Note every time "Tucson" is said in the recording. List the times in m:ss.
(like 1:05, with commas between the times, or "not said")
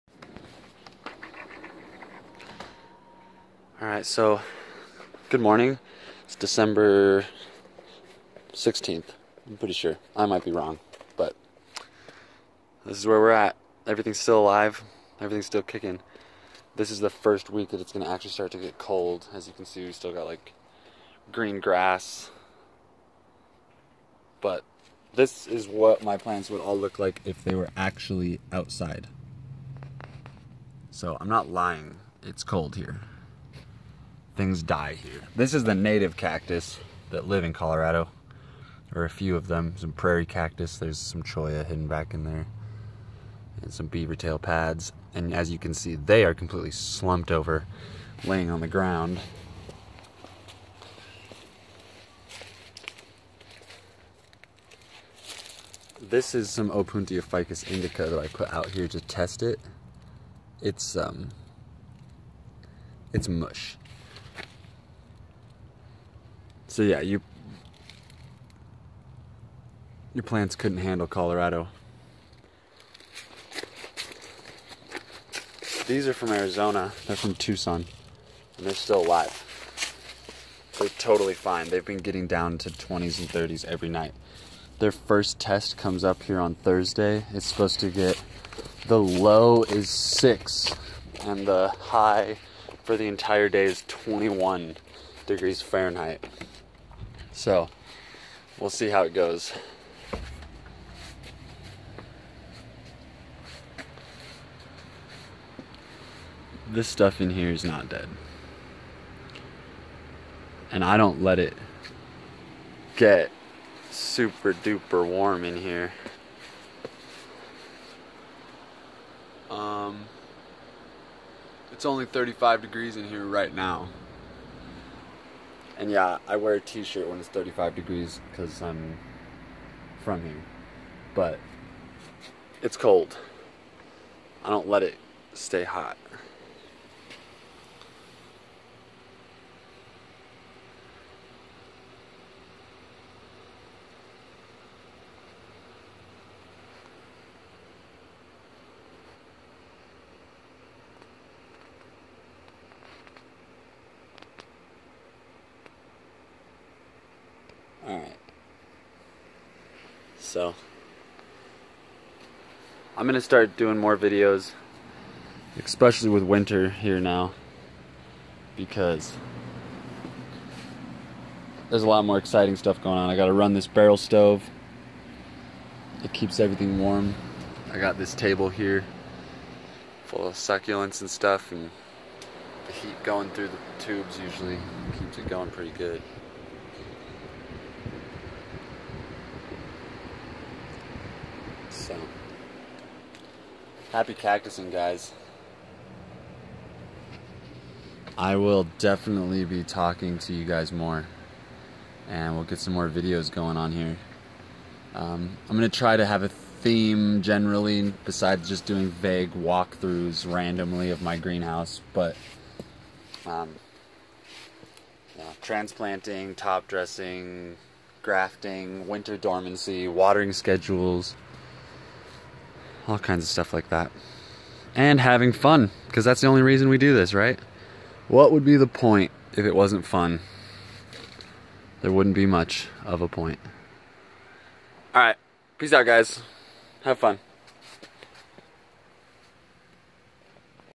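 1:17.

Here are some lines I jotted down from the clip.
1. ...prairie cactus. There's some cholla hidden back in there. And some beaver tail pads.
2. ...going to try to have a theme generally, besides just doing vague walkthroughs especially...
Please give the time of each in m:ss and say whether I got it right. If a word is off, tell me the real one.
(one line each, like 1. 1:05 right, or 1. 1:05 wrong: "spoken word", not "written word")
1. 0:39 right
2. 3:25 wrong: "randomly", not "especially".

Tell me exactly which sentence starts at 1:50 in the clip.
And I don't let it get super duper warm in here.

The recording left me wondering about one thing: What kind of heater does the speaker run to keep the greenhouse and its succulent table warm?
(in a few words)
barrel stove.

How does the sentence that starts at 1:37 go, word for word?
So we'll see how it goes.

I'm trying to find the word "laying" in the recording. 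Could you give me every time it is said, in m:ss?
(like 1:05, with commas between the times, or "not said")
0:48.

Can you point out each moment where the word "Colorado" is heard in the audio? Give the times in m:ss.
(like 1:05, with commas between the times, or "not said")
0:37, 1:11.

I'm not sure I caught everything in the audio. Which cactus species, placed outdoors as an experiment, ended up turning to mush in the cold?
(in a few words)
Opuntia ficus indica.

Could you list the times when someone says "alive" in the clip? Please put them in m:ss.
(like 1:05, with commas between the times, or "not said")
0:14, 1:19.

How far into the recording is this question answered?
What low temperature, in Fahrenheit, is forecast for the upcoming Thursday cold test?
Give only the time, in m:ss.
1:29.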